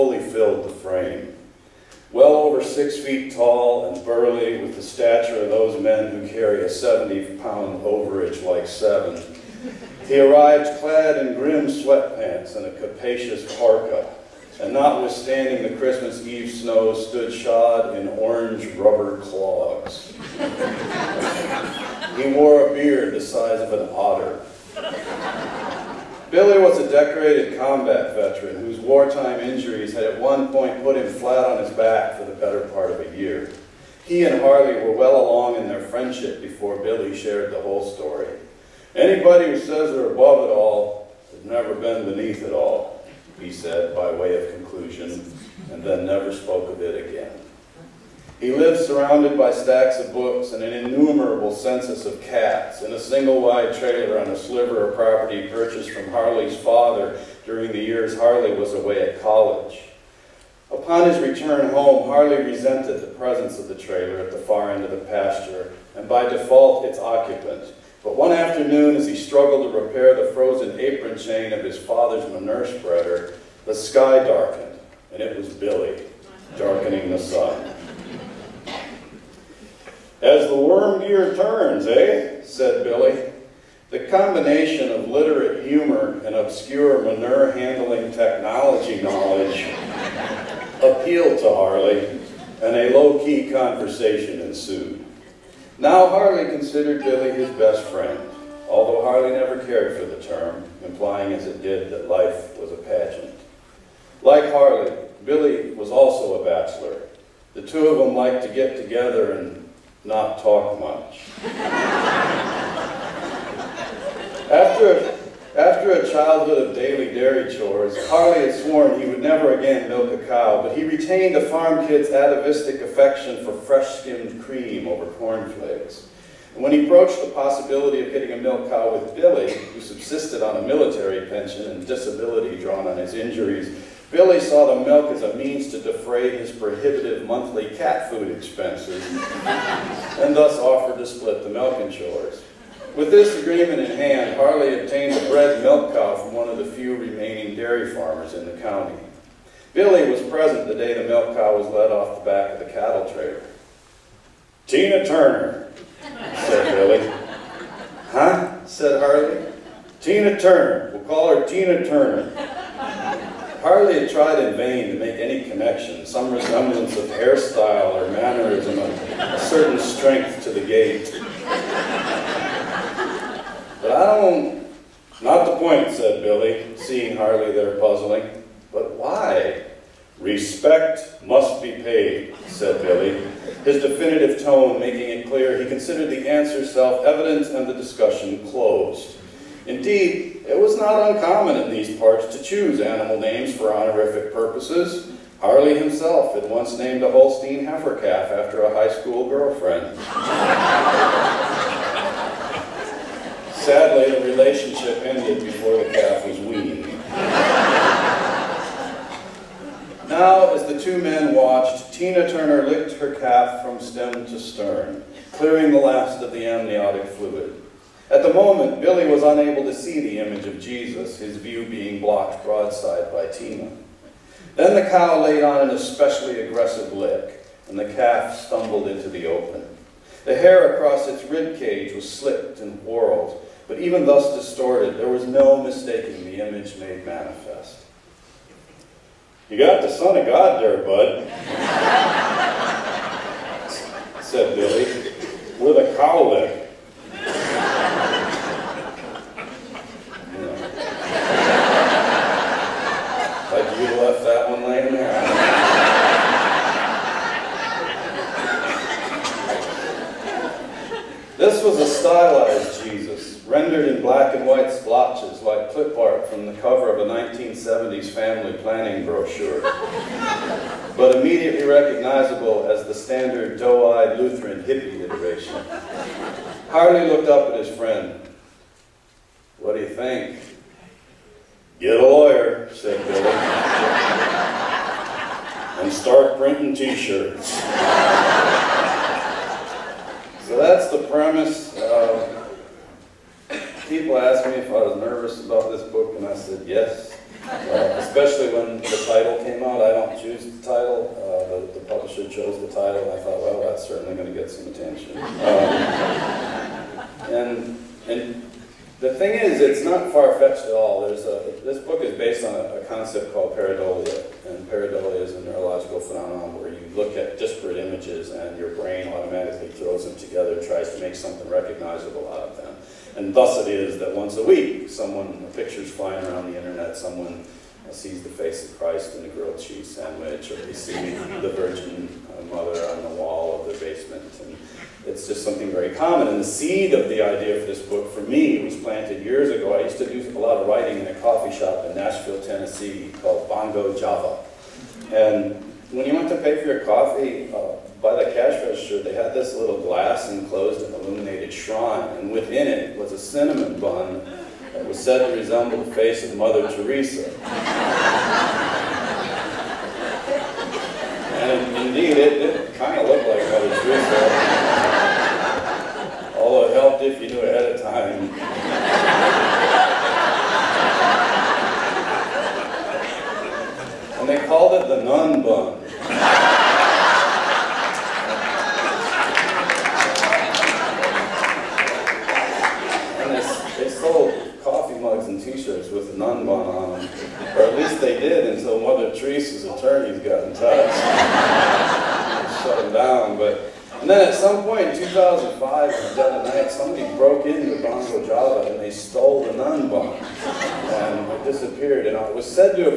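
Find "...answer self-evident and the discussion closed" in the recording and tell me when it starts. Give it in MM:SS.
03:06.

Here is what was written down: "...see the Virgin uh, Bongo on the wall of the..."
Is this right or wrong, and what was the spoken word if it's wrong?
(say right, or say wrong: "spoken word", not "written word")
wrong: "Mother", not "Bongo".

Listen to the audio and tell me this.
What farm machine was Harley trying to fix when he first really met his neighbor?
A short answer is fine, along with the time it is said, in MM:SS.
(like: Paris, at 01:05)
Manure spreader, at 01:12.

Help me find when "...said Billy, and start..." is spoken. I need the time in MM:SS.
04:42.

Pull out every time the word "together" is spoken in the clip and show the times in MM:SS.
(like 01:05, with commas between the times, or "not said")
01:48, 05:20.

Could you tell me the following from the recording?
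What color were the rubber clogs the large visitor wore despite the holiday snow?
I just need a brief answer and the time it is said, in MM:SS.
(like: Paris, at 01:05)
Orange, at 00:18.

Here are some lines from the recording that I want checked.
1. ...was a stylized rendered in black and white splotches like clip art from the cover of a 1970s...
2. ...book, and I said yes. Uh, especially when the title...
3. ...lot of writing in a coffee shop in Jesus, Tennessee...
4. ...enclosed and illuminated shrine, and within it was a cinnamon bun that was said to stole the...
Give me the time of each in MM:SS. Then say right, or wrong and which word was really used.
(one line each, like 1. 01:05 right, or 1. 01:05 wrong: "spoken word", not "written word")
1. 04:21 right
2. 04:55 right
3. 05:40 wrong: "Nashville", not "Jesus"
4. 05:50 wrong: "resemble", not "stole".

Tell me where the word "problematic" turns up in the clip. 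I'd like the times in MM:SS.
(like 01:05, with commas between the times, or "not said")
not said.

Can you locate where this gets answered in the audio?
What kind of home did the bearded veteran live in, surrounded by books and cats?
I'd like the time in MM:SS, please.
00:52.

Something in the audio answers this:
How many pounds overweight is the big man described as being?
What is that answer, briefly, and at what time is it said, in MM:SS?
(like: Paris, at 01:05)
70, at 00:06.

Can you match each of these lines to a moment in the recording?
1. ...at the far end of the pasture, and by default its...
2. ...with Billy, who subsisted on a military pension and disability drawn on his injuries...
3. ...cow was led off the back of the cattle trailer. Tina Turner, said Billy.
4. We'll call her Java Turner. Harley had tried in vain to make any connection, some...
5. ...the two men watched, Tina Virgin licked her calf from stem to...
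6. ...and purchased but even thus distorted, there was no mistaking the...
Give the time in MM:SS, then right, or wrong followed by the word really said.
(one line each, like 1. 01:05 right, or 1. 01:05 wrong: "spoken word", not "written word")
1. 01:04 right
2. 02:08 right
3. 02:31 right
4. 02:40 wrong: "Tina", not "Java"
5. 03:30 wrong: "Turner", not "Virgin"
6. 03:52 wrong: "whorled", not "purchased".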